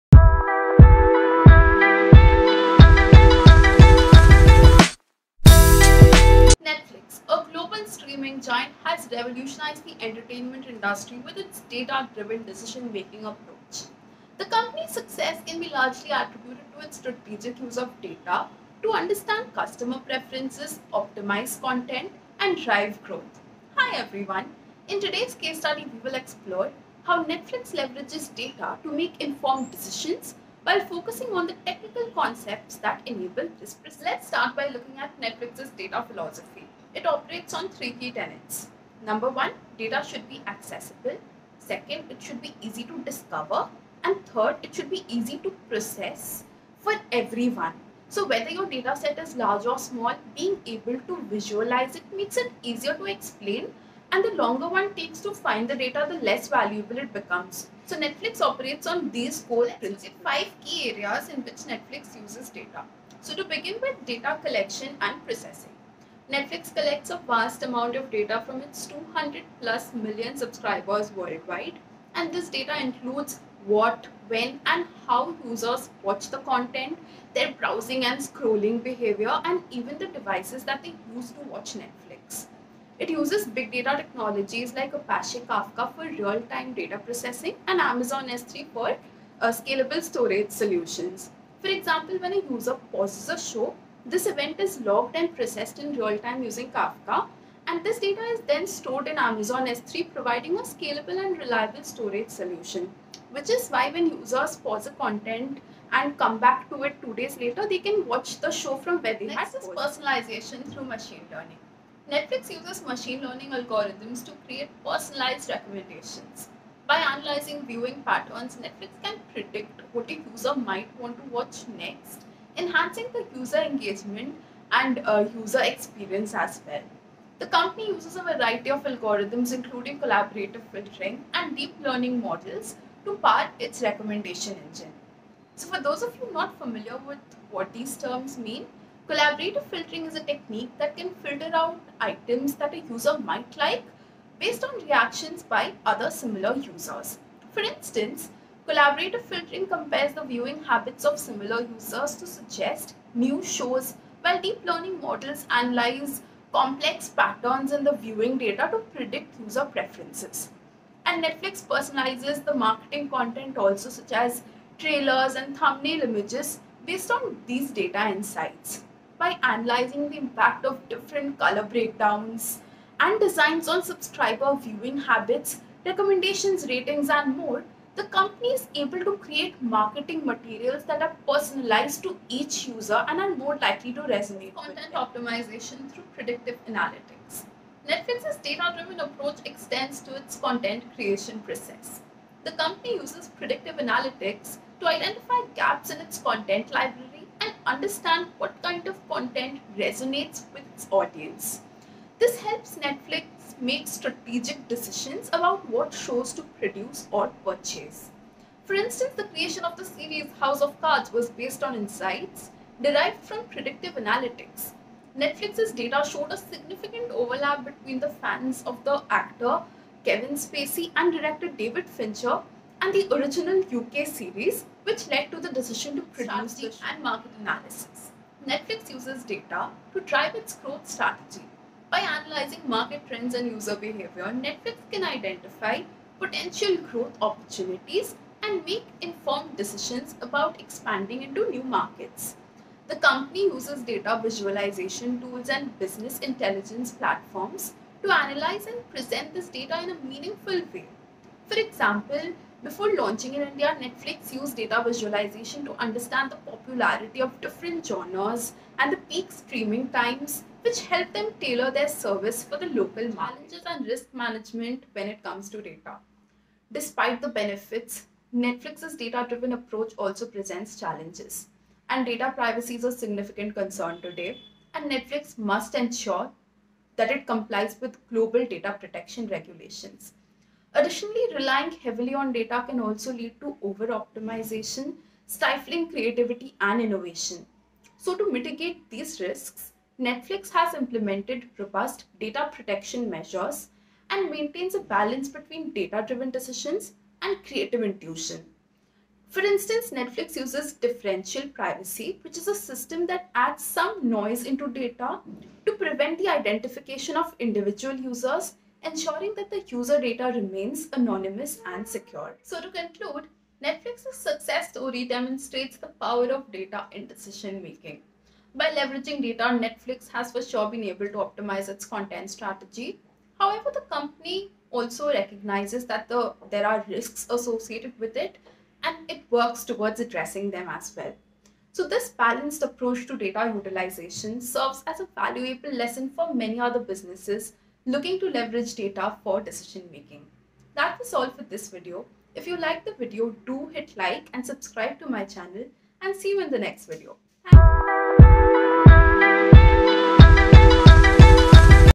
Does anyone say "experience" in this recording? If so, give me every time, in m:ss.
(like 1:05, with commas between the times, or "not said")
2:05.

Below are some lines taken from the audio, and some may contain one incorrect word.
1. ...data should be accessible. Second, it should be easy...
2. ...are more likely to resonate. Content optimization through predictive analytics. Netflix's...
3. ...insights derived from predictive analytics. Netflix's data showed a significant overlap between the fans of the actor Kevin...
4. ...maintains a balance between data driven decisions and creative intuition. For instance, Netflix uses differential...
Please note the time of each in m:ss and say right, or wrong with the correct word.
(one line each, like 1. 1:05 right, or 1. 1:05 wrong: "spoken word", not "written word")
1. 0:39 right
2. 3:03 right
3. 3:31 right
4. 4:54 right.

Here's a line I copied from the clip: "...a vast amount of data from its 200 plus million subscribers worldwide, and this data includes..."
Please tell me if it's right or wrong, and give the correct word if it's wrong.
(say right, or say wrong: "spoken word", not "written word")
right.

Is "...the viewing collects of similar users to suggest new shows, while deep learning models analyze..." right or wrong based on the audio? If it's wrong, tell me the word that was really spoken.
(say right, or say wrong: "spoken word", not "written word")
wrong: "habits", not "collects".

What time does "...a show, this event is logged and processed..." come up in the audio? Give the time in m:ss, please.
1:33.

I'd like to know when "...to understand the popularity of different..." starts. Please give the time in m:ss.
4:15.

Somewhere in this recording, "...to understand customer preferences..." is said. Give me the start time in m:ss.
0:18.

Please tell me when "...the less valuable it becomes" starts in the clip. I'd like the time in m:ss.
0:56.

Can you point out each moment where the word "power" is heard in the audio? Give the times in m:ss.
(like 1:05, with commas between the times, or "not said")
2:13, 5:15.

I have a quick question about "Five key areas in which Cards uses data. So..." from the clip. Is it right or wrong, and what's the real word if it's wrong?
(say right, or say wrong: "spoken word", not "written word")
wrong: "Netflix", not "Cards".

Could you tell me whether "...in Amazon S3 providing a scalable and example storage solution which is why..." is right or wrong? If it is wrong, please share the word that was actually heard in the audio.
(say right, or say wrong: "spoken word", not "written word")
wrong: "reliable", not "example".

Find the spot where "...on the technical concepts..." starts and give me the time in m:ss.
0:31.